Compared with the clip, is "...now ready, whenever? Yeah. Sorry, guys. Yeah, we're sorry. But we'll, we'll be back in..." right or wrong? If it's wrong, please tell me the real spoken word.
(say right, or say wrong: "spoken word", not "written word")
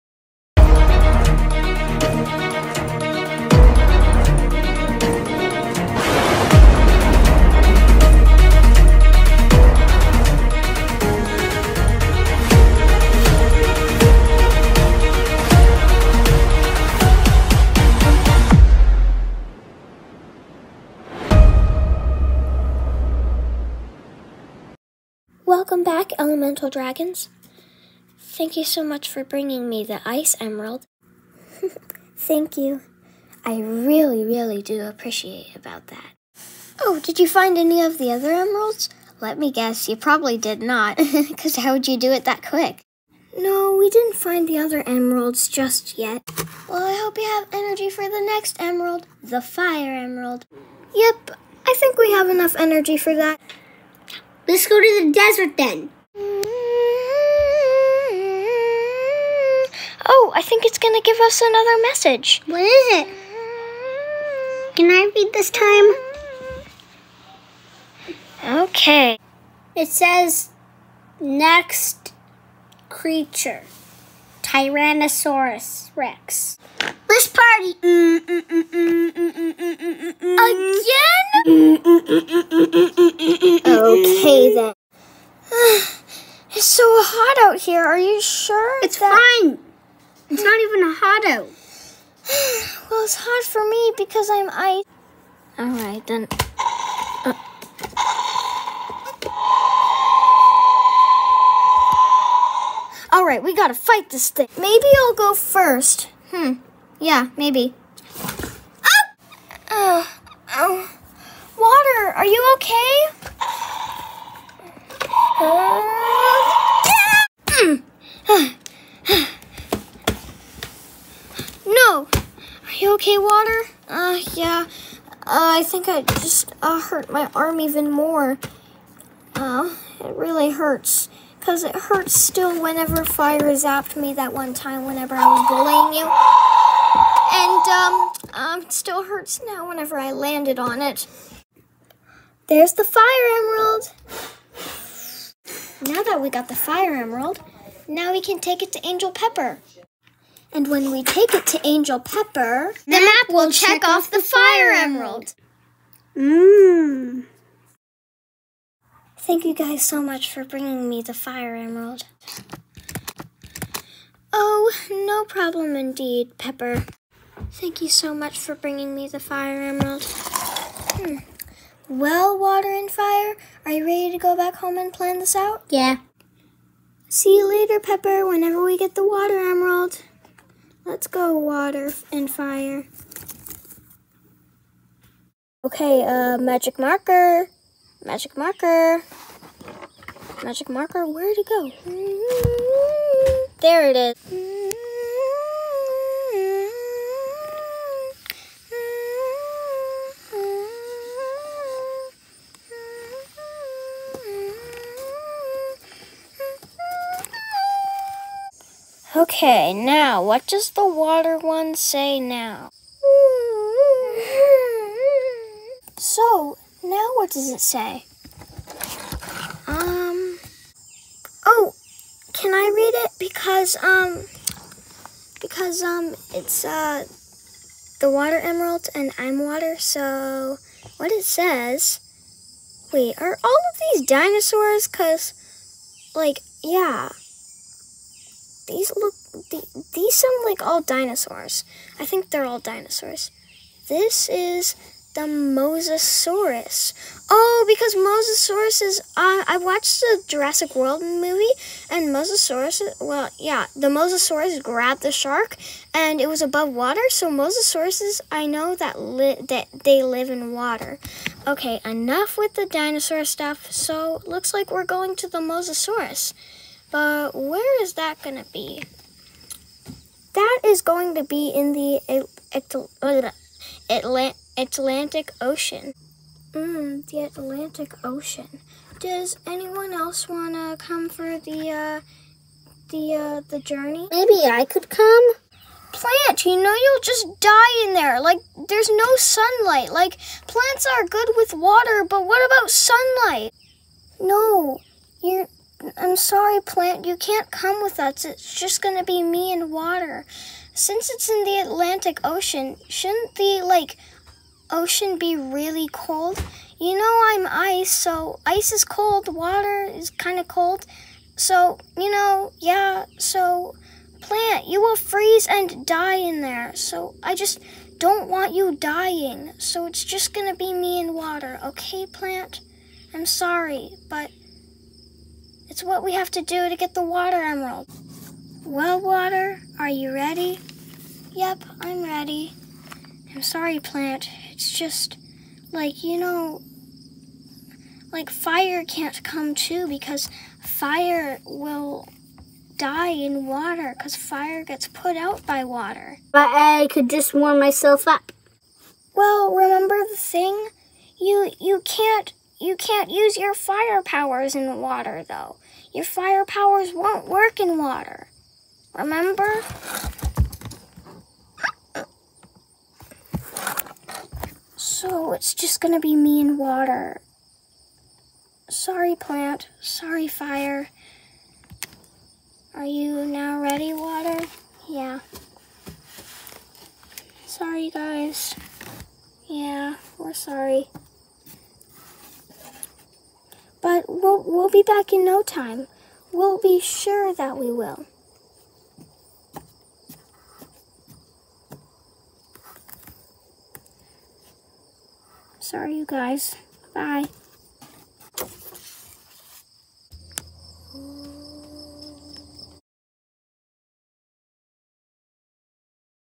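wrong: "water", not "whenever".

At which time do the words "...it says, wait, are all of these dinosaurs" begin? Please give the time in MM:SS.
03:51.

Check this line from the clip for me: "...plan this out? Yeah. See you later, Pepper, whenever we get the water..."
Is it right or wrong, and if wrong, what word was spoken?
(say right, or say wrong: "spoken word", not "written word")
right.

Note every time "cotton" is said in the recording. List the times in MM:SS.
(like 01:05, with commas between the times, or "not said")
not said.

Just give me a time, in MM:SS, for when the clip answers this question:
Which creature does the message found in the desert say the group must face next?
01:14.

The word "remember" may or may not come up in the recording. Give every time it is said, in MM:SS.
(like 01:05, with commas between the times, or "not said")
05:49, 05:58.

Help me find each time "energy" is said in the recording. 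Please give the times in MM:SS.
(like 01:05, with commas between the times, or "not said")
00:47, 00:52.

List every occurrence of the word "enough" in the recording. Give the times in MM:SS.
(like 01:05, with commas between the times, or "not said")
00:52, 04:21.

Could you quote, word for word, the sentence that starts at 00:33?
I really, really do appreciate about that.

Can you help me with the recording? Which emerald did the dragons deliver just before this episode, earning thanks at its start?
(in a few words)
Ice Emerald.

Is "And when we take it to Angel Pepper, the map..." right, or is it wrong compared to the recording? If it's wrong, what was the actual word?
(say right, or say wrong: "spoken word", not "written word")
right.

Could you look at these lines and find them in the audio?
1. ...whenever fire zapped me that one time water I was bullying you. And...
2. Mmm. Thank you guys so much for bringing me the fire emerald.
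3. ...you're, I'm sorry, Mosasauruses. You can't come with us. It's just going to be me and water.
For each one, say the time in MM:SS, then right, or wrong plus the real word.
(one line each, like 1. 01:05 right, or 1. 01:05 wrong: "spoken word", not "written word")
1. 02:12 wrong: "whenever", not "water"
2. 02:36 right
3. 04:55 wrong: "Plant", not "Mosasauruses".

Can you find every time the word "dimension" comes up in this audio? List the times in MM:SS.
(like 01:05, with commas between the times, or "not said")
not said.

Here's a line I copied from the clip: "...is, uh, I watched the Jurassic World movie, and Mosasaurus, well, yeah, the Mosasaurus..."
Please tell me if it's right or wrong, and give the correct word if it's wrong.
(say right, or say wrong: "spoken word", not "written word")
right.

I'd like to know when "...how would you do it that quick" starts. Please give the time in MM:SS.
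00:41.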